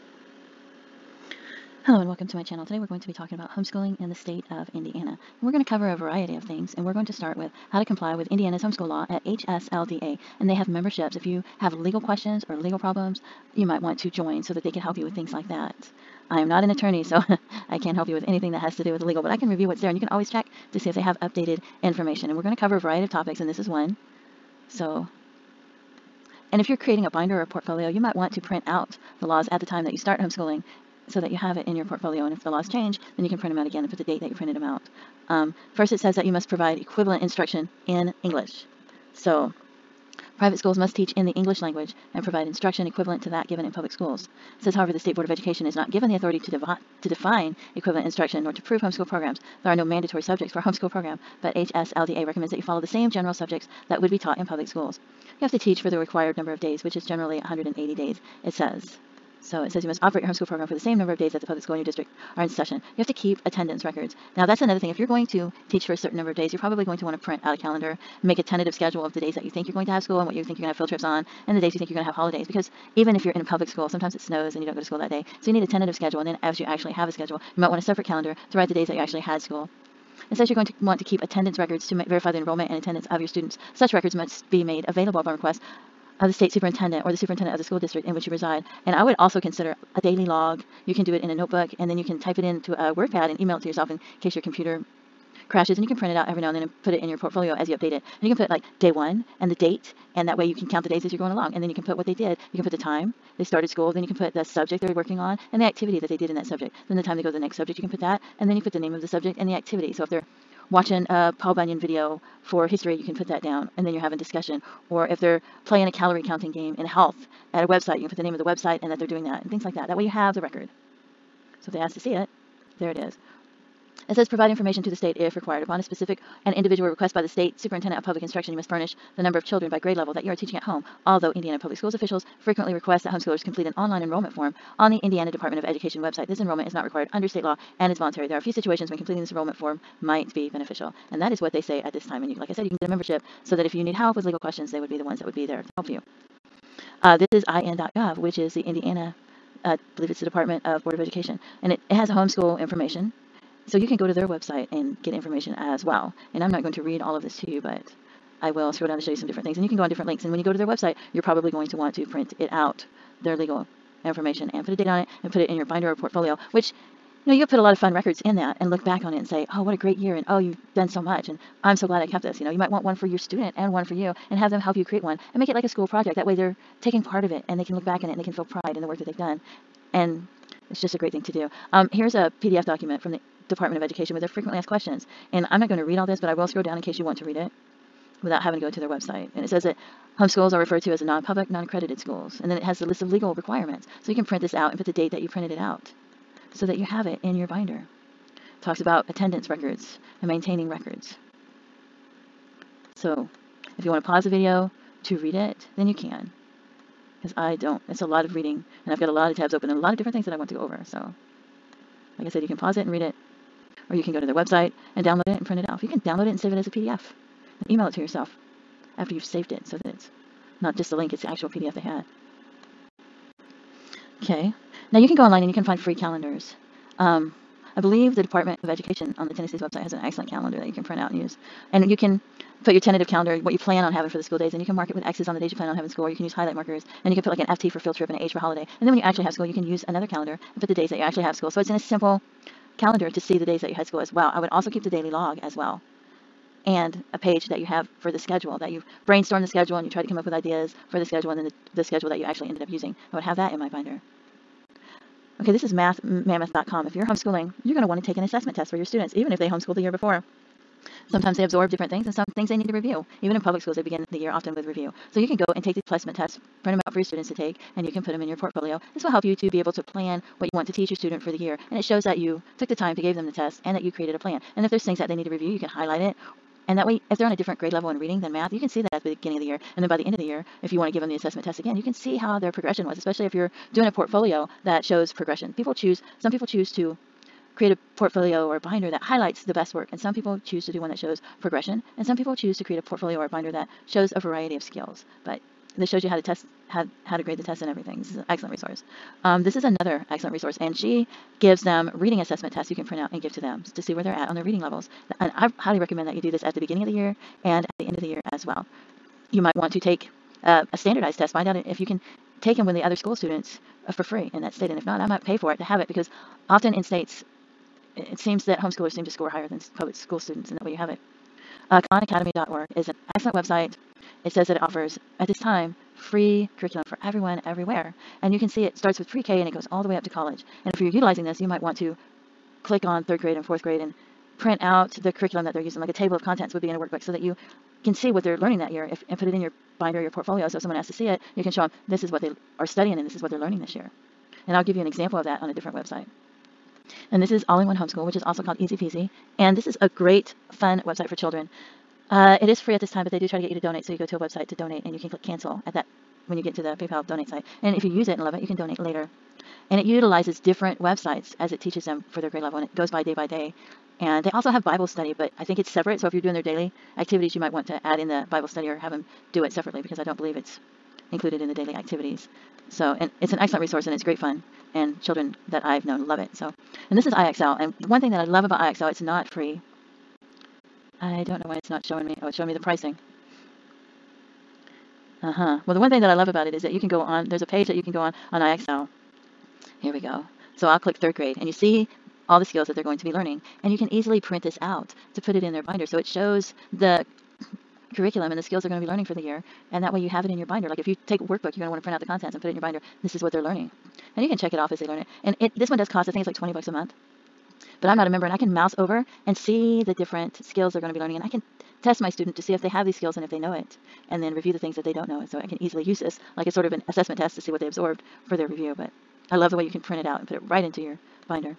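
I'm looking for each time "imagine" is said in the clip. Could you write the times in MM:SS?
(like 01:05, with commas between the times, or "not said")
not said.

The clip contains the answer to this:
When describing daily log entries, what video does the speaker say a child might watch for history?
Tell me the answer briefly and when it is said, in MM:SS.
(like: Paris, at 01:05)
Paul Bunyan, at 01:51.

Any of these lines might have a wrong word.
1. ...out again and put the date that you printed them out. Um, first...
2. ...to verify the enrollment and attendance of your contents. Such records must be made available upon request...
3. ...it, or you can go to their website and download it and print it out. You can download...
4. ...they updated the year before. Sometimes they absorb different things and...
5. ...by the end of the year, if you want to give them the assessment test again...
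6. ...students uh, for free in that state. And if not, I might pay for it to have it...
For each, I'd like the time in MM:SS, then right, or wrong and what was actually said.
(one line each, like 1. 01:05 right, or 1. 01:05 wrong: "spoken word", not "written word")
1. 00:33 right
2. 01:21 wrong: "students", not "contents"
3. 03:32 right
4. 04:19 wrong: "homeschooled", not "updated"
5. 04:39 right
6. 05:13 right.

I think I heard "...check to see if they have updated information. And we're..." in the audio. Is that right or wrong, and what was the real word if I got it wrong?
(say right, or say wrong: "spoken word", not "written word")
right.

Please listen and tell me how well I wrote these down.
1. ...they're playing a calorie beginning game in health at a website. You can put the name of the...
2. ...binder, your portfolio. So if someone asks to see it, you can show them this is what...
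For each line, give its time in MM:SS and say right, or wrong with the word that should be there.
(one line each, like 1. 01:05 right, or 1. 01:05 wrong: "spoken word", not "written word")
1. 01:55 wrong: "counting", not "beginning"
2. 05:39 right.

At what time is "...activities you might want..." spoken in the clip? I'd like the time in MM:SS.
06:06.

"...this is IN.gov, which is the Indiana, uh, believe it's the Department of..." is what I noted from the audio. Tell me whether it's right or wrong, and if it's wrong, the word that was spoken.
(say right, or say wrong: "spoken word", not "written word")
right.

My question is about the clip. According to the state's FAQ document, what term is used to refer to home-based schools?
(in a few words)
non-public, non-accredited schools.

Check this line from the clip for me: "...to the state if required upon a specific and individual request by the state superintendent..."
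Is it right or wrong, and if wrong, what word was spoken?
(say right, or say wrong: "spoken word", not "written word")
right.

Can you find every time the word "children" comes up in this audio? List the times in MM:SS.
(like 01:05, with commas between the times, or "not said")
02:09, 05:51, 06:15.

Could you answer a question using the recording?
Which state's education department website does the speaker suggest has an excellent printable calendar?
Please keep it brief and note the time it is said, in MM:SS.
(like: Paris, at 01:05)
Tennessee, at 03:49.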